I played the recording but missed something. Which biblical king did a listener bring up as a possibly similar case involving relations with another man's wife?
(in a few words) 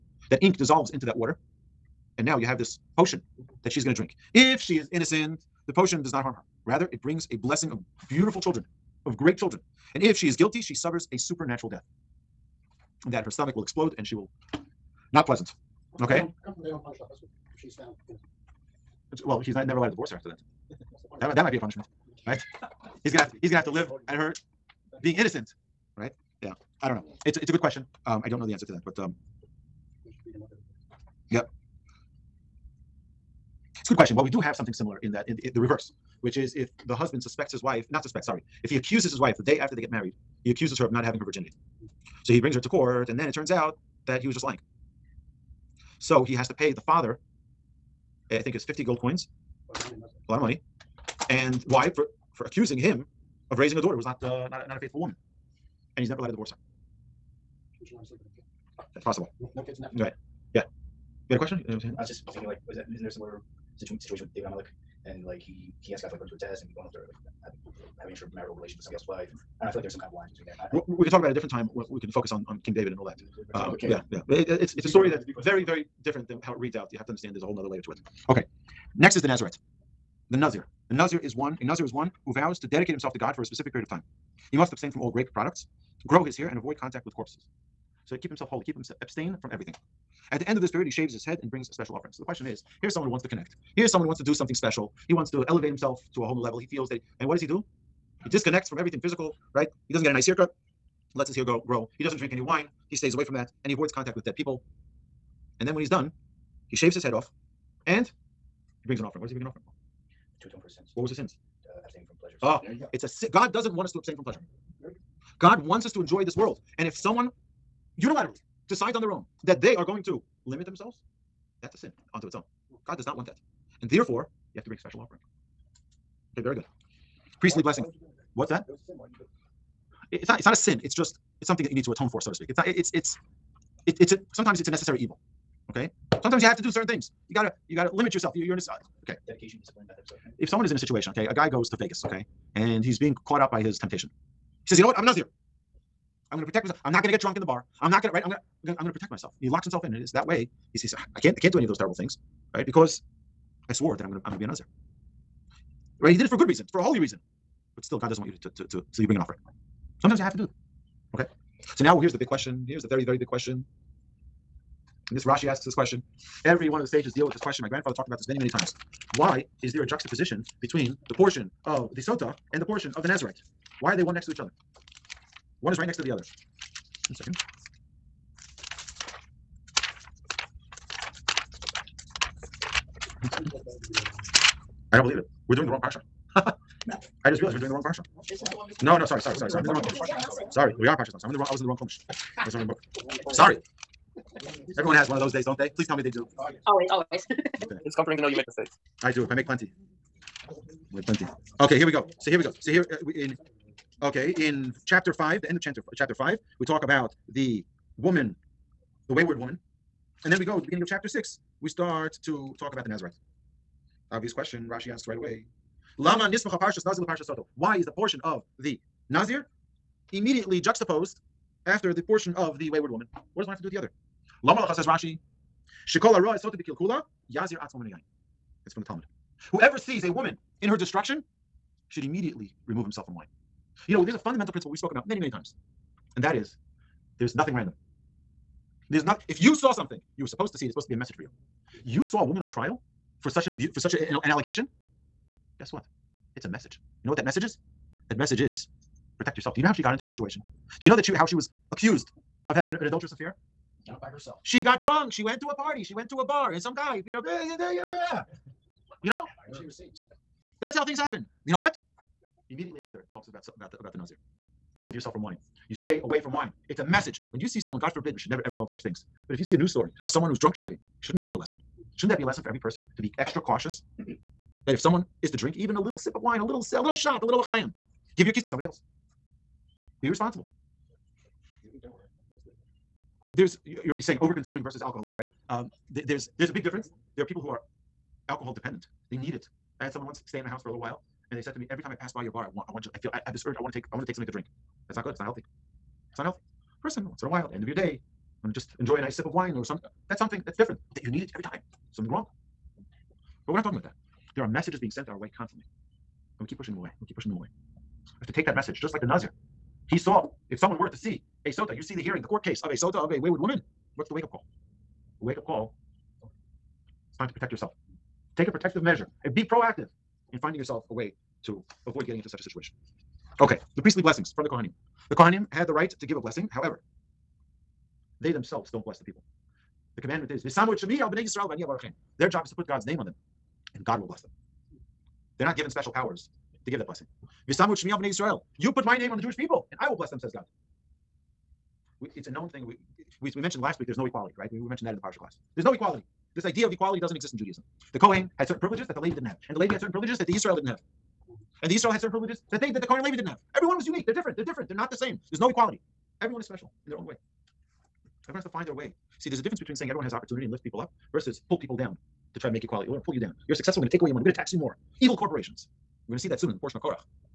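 David HaMelech.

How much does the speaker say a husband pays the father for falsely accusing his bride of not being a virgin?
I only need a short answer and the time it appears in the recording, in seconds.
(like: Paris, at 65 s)
50 gold coins, at 48 s.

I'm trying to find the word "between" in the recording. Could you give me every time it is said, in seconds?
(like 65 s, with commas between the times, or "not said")
70 s, 170 s, 359 s.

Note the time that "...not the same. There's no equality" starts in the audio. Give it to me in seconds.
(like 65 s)
354 s.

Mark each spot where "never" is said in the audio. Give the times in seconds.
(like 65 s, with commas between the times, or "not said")
19 s, 56 s, 268 s.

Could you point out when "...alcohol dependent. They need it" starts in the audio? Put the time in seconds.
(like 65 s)
288 s.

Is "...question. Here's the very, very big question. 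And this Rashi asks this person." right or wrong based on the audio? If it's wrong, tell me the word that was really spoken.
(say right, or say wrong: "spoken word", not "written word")
wrong: "question", not "person".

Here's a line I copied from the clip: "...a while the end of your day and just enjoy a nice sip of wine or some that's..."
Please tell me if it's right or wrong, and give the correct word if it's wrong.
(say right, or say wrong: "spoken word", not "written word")
right.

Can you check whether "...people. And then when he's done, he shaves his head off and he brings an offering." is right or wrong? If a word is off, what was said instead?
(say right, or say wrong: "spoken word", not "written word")
right.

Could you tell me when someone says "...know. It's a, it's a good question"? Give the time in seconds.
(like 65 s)
26 s.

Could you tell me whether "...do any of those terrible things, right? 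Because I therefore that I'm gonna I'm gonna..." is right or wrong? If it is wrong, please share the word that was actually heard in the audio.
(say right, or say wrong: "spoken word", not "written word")
wrong: "swore", not "therefore".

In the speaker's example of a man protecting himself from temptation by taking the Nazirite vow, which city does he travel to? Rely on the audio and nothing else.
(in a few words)
Vegas.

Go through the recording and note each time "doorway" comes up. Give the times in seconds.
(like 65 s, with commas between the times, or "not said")
not said.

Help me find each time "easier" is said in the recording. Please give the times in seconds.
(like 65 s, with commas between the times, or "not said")
not said.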